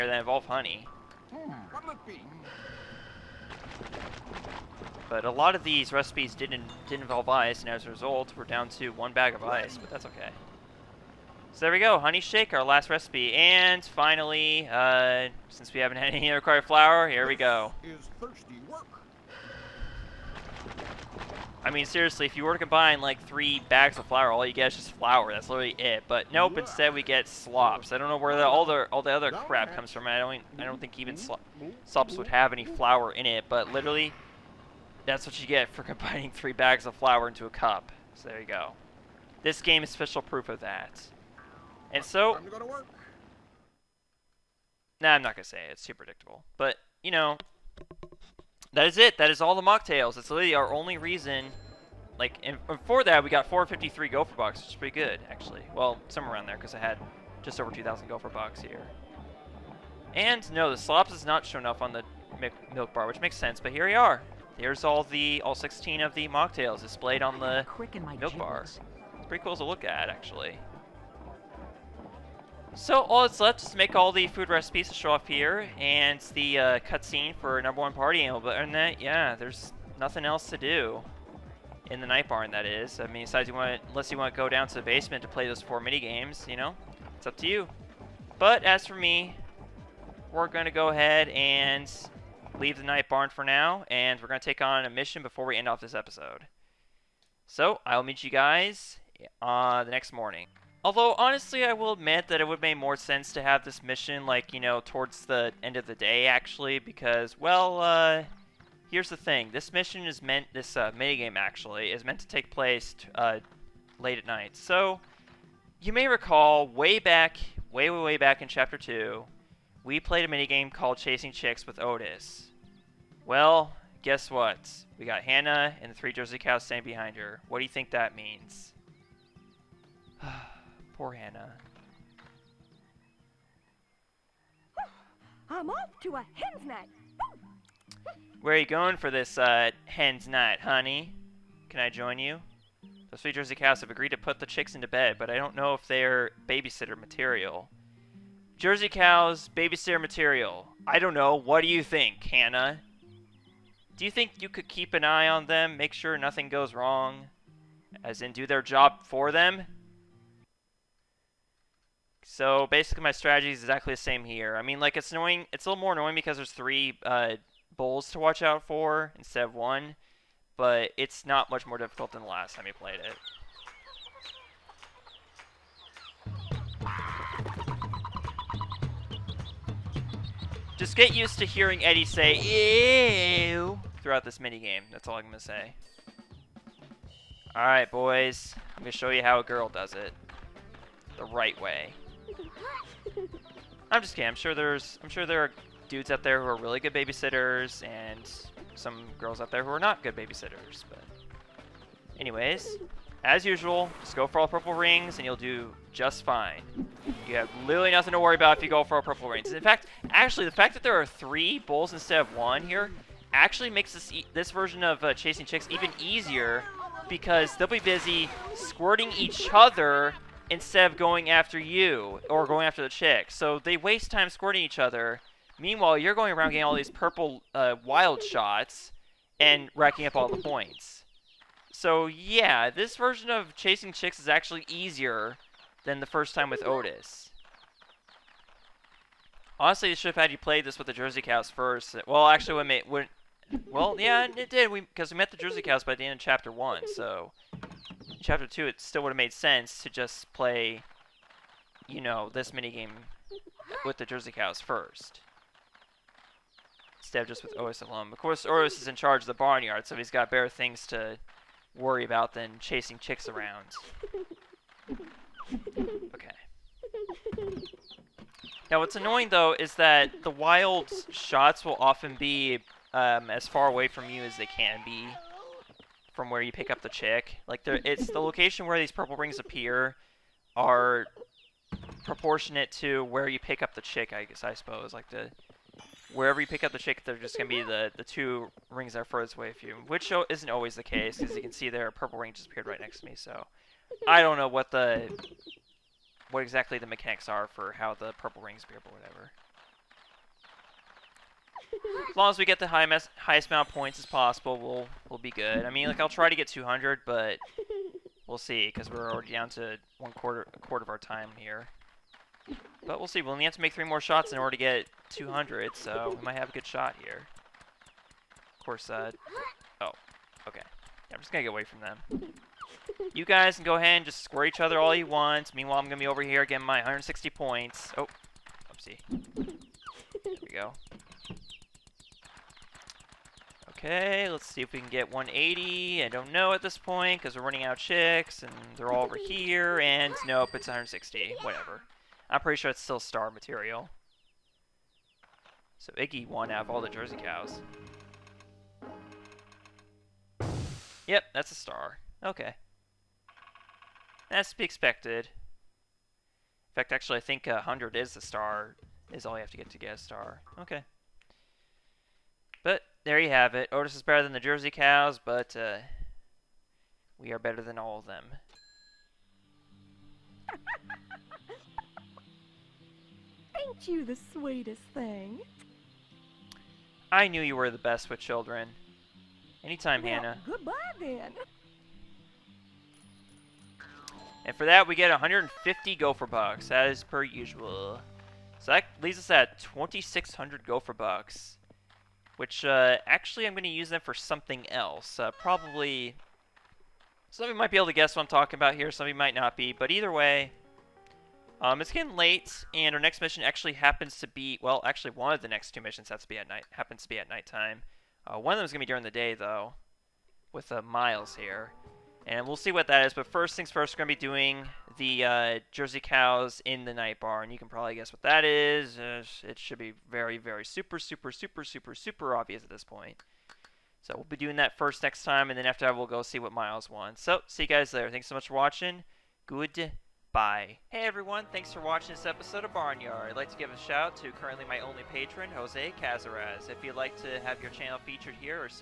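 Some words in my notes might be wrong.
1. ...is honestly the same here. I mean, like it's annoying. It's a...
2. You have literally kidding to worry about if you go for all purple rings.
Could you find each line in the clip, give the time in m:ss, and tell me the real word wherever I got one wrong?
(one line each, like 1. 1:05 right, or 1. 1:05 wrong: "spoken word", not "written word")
1. 2:43 wrong: "exactly", not "honestly"
2. 3:27 wrong: "nothing", not "kidding".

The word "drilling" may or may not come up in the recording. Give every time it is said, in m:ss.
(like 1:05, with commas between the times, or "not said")
not said.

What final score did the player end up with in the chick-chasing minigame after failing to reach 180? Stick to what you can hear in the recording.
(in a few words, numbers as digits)
160.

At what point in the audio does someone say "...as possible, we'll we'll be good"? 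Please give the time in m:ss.
5:03.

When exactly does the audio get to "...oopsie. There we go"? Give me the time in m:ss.
5:28.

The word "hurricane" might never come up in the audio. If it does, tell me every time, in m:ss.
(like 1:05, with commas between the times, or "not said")
not said.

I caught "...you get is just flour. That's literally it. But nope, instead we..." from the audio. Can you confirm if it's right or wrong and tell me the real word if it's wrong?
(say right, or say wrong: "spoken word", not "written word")
right.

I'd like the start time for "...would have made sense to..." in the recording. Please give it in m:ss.
4:09.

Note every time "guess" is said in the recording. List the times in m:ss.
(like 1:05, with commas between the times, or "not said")
2:04, 4:44, 6:37, 6:57.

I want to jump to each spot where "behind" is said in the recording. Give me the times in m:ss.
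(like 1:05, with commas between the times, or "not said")
2:06.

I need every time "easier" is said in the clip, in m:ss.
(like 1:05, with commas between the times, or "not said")
3:35, 3:54.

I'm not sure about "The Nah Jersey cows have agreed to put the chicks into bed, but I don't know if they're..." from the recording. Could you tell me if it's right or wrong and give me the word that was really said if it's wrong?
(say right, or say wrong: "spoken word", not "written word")
wrong: "Sweet", not "Nah".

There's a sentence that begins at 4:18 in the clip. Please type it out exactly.
Of course, Otis is in charge of the barnyard, so he's got better things to worry about than chasing chicks around.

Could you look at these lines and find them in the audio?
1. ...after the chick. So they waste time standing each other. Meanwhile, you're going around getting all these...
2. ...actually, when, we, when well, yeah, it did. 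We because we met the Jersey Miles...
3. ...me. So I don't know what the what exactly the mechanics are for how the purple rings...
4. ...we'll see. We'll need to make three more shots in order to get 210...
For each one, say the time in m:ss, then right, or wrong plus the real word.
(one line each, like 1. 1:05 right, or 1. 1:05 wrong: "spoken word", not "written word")
1. 3:42 wrong: "squirting", not "standing"
2. 4:02 wrong: "Cows", not "Miles"
3. 4:53 right
4. 5:12 wrong: "200", not "210".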